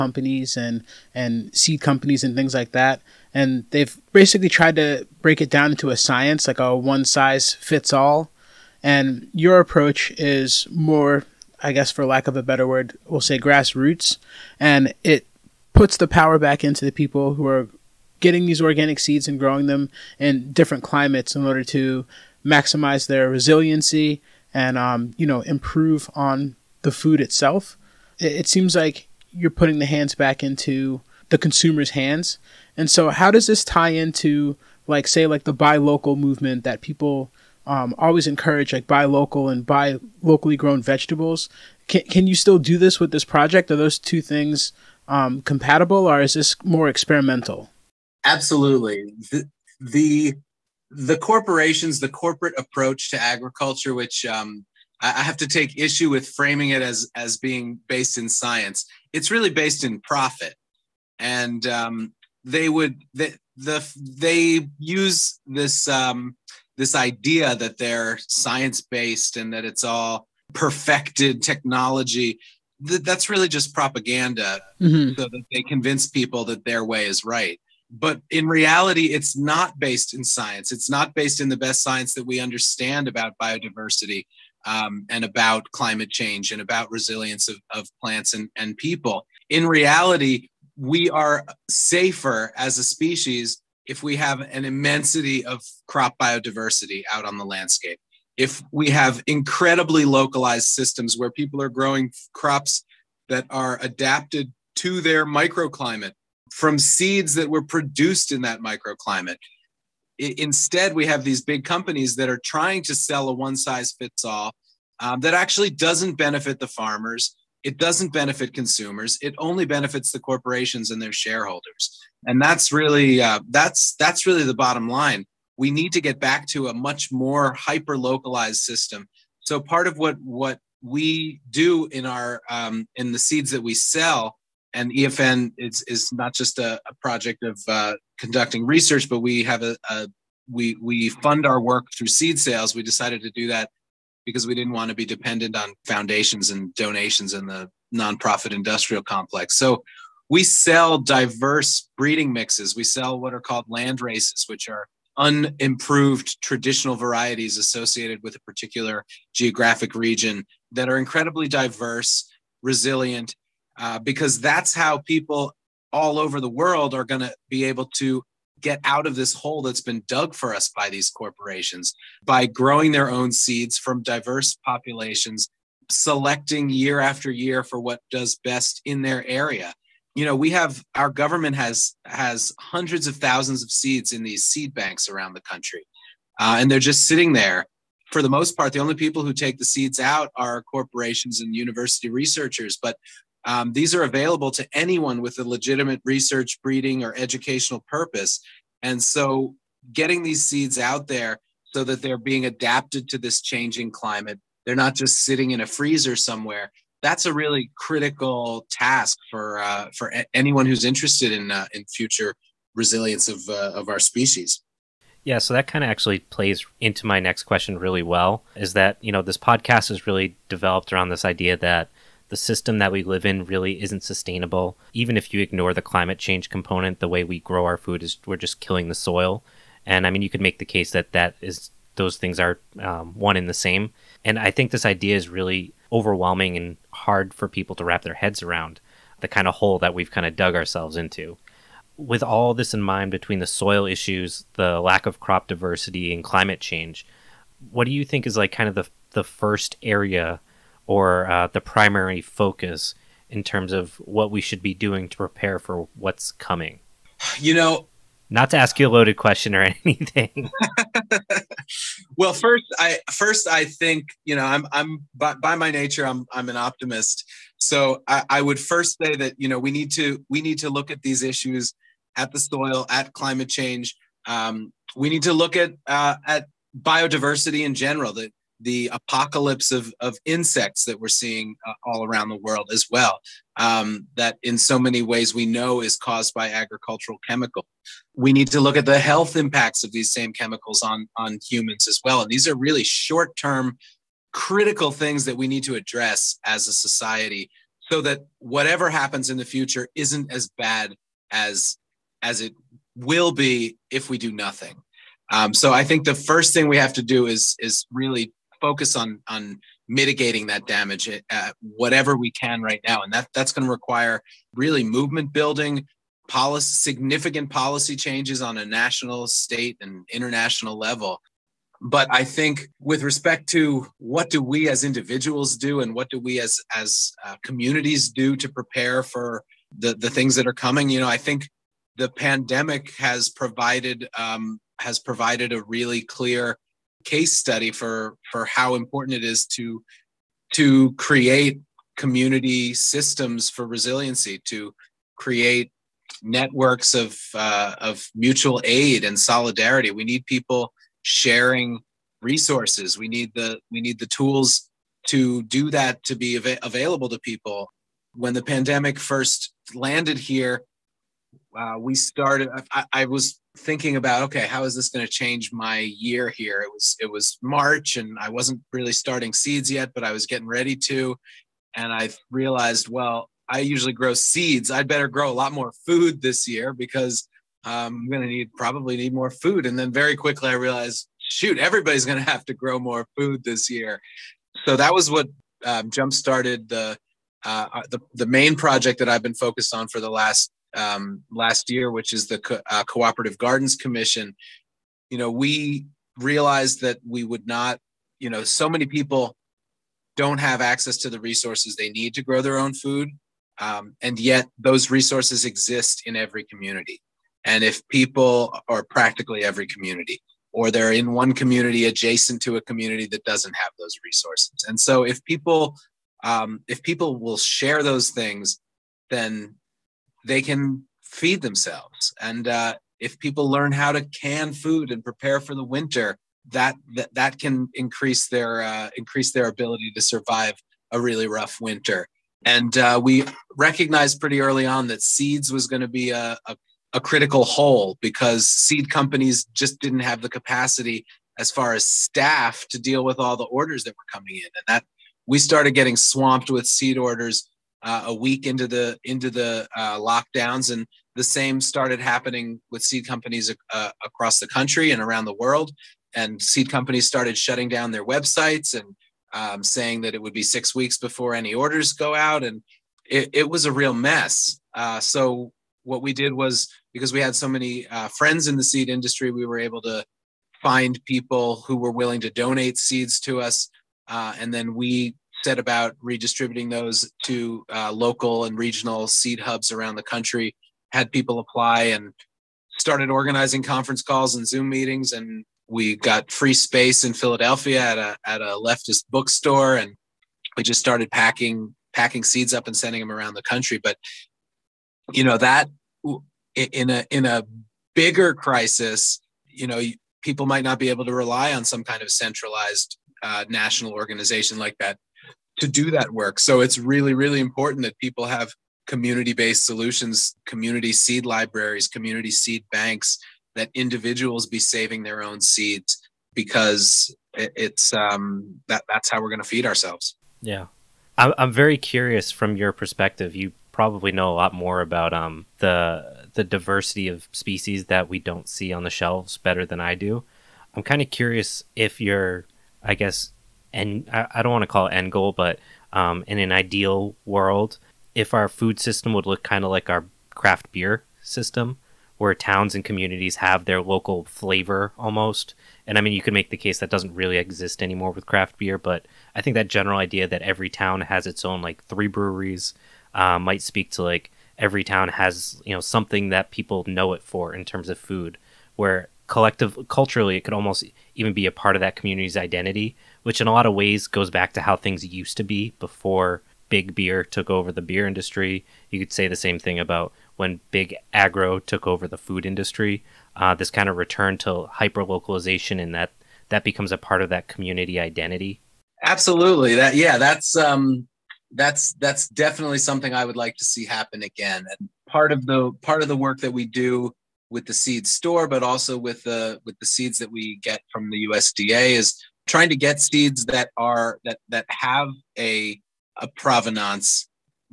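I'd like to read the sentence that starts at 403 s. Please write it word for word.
Um, and yet those resources exist in every community.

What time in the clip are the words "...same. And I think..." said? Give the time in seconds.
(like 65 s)
233 s.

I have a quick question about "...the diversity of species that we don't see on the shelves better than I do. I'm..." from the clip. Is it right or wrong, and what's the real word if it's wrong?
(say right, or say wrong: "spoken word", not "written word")
right.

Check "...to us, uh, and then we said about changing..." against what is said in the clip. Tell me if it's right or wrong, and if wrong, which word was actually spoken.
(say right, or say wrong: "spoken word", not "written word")
wrong: "redistributing", not "changing".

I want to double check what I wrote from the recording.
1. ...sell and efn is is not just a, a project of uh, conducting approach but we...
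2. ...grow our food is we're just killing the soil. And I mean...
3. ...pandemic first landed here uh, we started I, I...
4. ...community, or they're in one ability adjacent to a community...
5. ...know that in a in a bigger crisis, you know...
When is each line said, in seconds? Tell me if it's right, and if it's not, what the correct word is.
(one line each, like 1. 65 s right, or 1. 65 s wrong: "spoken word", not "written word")
1. 133 s wrong: "research", not "approach"
2. 227 s right
3. 358 s right
4. 409 s wrong: "community", not "ability"
5. 495 s right.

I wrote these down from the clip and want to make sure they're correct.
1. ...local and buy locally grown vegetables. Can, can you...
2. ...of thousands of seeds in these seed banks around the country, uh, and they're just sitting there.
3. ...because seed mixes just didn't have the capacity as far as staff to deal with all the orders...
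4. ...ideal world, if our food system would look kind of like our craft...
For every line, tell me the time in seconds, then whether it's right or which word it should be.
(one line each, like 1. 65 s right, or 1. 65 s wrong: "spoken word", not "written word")
1. 39 s right
2. 183 s right
3. 438 s wrong: "companies", not "mixes"
4. 536 s right.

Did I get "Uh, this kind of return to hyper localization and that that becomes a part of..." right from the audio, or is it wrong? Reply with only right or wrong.
right.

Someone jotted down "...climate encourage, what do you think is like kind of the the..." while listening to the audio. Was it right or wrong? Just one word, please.
wrong.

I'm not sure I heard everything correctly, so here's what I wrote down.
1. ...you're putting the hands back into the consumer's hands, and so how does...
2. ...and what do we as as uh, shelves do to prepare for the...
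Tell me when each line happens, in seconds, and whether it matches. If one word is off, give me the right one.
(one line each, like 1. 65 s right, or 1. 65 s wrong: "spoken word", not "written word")
1. 29 s right
2. 325 s wrong: "communities", not "shelves".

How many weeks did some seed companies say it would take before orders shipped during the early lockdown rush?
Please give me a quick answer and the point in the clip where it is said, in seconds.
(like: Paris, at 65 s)
6, at 460 s.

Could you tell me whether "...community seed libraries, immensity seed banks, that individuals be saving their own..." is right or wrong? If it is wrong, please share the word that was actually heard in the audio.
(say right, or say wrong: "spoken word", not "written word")
wrong: "community", not "immensity".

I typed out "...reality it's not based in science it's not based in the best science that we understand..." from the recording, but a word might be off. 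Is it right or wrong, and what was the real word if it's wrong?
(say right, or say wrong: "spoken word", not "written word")
right.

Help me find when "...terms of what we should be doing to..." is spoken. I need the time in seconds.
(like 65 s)
253 s.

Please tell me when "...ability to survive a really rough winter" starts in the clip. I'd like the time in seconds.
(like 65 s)
429 s.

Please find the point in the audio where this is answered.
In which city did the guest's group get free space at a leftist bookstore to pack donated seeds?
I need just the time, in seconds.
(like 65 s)
487 s.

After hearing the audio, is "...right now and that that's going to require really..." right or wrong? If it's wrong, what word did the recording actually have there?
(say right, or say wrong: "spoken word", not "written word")
right.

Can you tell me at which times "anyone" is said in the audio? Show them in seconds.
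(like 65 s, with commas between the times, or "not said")
194 s, 210 s.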